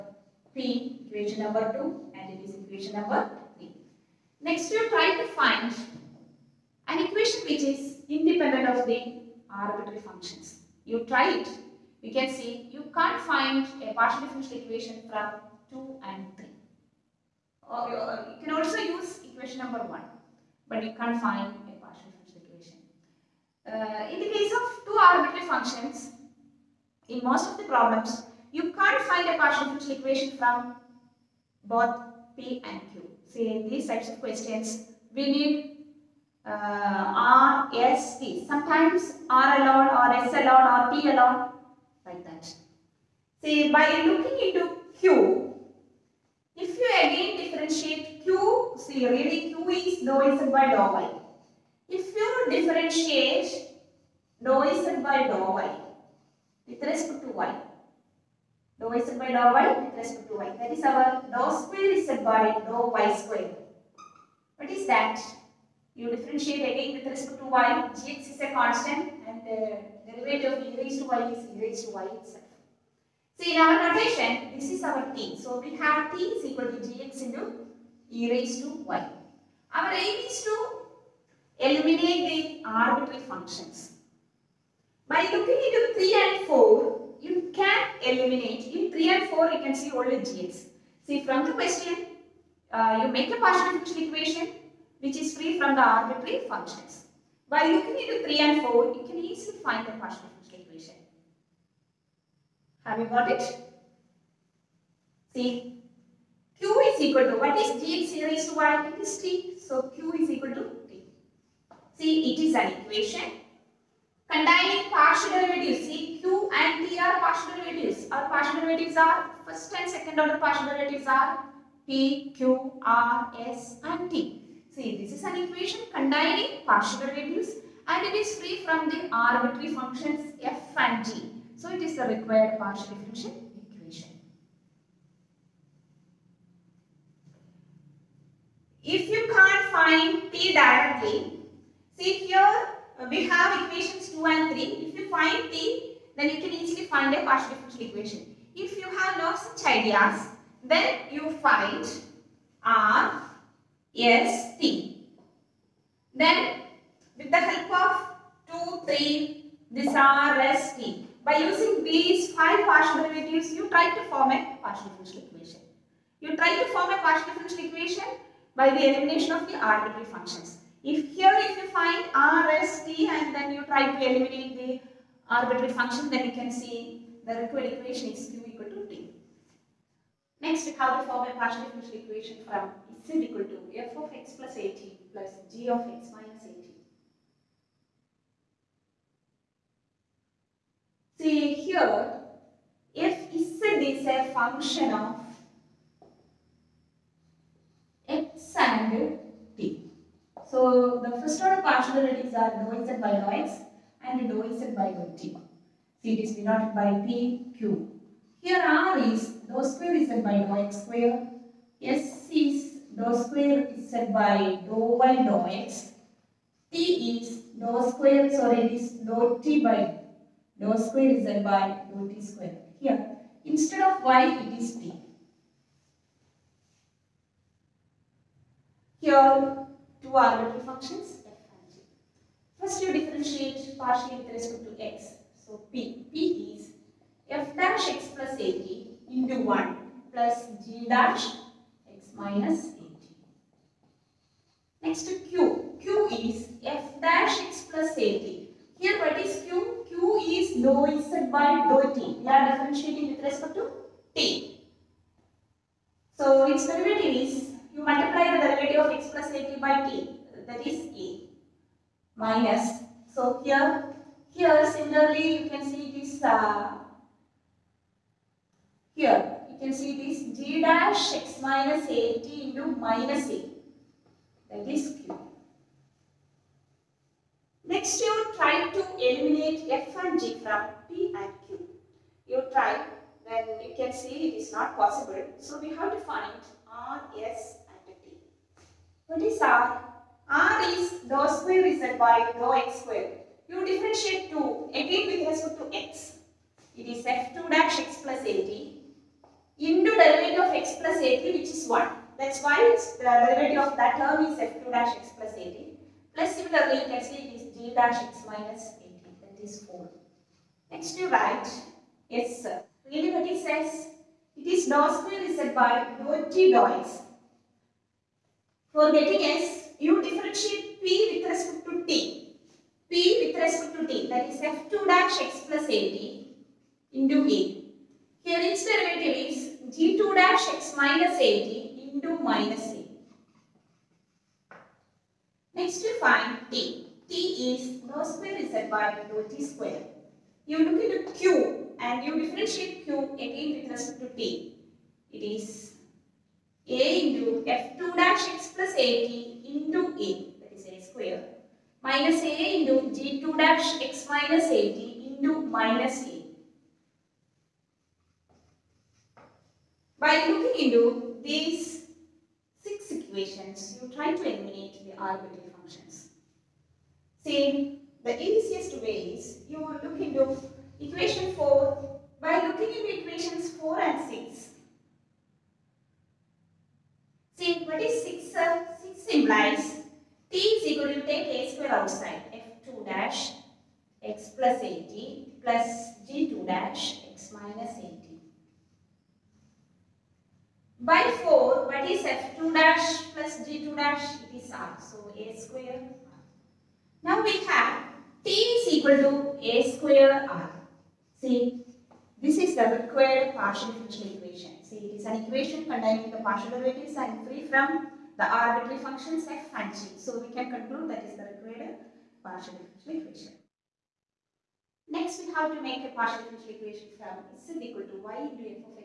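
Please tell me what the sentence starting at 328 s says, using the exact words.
Here its derivative is G2 dash X minus AT into minus c.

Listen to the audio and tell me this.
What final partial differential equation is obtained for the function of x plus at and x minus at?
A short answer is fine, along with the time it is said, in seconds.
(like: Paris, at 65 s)
t = a²r, at 398 s.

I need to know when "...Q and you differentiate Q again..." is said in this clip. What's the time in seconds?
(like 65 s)
341 s.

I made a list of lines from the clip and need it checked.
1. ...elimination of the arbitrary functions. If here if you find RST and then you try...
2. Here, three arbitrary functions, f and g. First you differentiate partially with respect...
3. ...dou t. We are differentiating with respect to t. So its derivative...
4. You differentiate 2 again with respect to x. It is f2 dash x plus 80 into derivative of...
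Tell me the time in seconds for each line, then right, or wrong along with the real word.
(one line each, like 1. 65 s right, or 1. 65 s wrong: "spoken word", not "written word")
1. 168 s right
2. 228 s wrong: "two", not "three"
3. 251 s right
4. 293 s right.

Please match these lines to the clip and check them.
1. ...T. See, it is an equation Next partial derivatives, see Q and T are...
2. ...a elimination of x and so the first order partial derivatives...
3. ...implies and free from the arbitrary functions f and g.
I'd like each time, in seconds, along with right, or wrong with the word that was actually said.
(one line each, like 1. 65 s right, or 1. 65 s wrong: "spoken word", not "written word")
1. 110 s wrong: "Containing", not "Next"
2. 194 s wrong: "function", not "elimination"
3. 406 s wrong: "derivatives", not "implies".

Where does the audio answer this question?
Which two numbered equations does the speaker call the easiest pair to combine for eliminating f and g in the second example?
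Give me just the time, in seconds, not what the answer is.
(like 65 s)
372 s.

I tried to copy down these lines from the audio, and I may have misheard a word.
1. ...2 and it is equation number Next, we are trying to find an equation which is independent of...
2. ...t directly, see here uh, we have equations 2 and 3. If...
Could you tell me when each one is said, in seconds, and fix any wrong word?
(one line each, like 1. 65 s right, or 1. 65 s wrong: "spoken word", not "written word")
1. 1 s right
2. 140 s right.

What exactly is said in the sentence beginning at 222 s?
Here, instead of y, it is t.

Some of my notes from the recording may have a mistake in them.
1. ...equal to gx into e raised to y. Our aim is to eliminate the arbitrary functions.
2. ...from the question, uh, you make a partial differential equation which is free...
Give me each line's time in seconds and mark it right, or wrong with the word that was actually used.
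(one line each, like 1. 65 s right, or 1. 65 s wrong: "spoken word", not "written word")
1. 76 s right
2. 91 s right.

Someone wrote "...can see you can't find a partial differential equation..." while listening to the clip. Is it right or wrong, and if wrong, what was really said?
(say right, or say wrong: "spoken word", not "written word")
right.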